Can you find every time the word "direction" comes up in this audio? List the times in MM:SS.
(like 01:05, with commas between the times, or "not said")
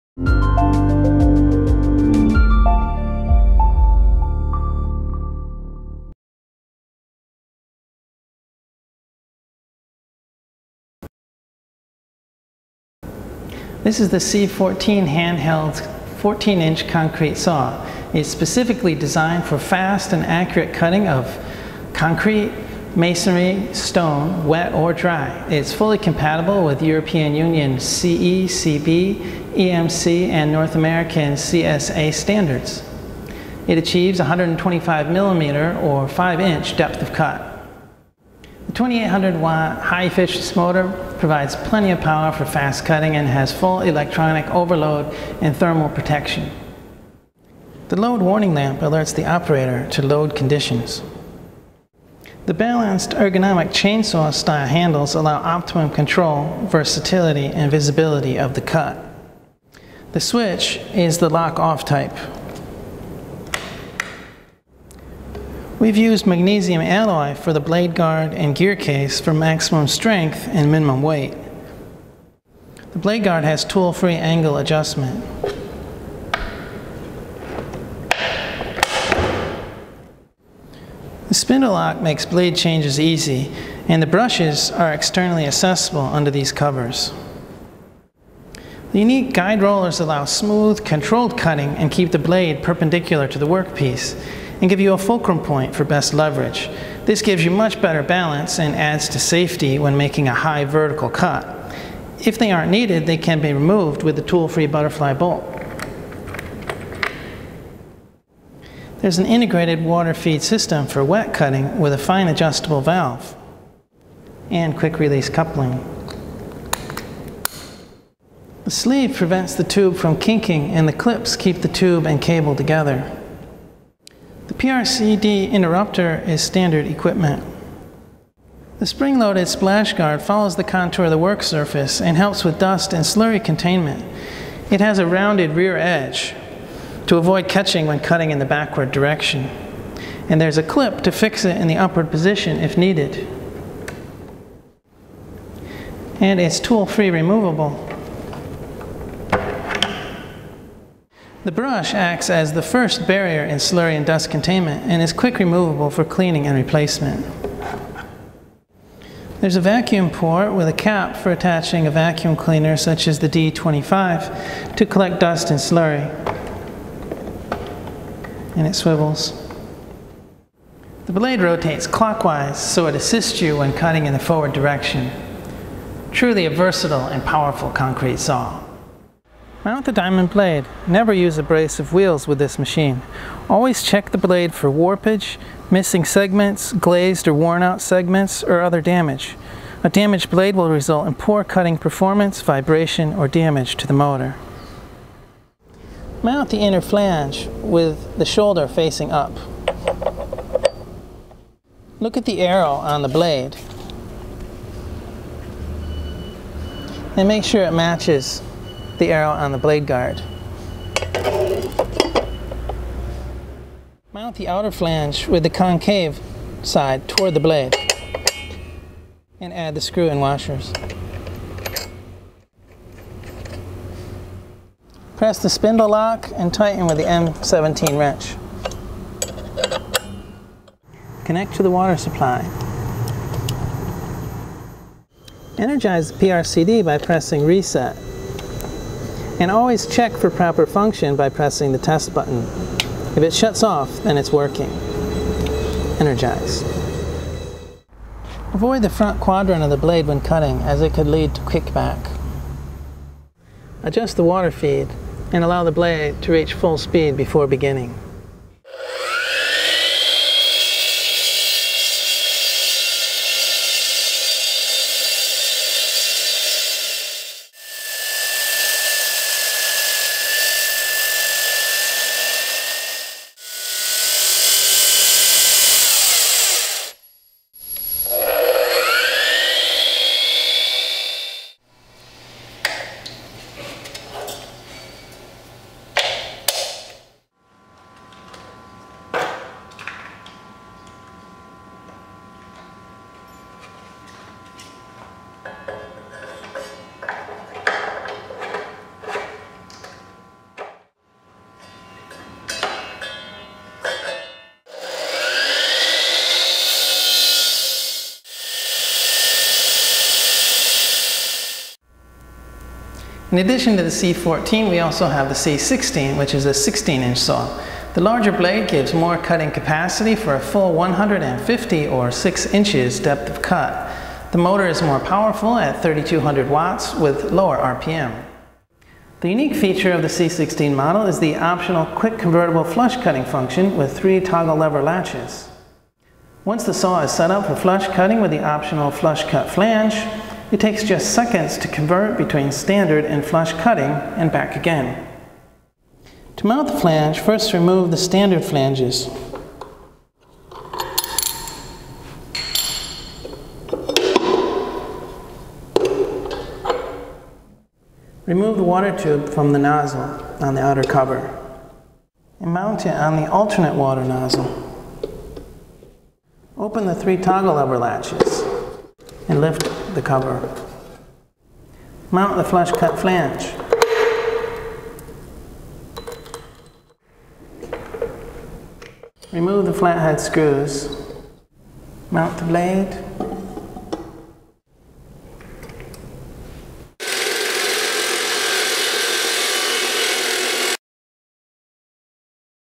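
02:18, 02:54.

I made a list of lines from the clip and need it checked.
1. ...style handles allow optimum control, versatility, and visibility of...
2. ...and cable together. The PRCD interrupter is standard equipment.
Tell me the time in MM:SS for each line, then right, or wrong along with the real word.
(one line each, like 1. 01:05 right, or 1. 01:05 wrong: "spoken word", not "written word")
1. 00:54 right
2. 02:02 right.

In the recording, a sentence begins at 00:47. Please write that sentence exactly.
The load warning lamp alerts the operator to load conditions.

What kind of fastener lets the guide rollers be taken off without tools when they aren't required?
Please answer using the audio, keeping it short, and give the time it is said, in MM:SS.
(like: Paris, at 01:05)
Butterfly bolt, at 01:44.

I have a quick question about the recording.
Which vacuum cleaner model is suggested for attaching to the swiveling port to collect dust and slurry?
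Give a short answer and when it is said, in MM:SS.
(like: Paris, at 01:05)
D25, at 02:43.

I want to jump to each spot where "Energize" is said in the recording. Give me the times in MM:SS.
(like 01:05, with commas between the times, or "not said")
03:55, 04:05.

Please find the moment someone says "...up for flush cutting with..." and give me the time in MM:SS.
05:37.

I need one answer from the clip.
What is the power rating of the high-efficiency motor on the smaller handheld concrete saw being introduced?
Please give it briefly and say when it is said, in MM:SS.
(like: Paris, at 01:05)
2800 watts, at 00:38.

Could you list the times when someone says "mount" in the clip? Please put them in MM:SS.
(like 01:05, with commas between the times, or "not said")
02:59, 03:16, 03:34, 05:46, 06:02, 06:12, 06:22.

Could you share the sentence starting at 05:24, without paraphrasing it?
The motor is more powerful at 3200 watts with lower RPM.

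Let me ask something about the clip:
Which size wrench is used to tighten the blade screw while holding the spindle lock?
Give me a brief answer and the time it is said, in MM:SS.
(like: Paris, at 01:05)
M17, at 03:47.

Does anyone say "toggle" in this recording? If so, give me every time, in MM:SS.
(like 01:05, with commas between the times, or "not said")
05:34, 06:07.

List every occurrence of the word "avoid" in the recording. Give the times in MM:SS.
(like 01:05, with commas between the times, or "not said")
02:17, 04:08.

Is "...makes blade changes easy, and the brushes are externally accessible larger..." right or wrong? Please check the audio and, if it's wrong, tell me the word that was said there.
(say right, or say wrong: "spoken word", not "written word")
wrong: "under", not "larger".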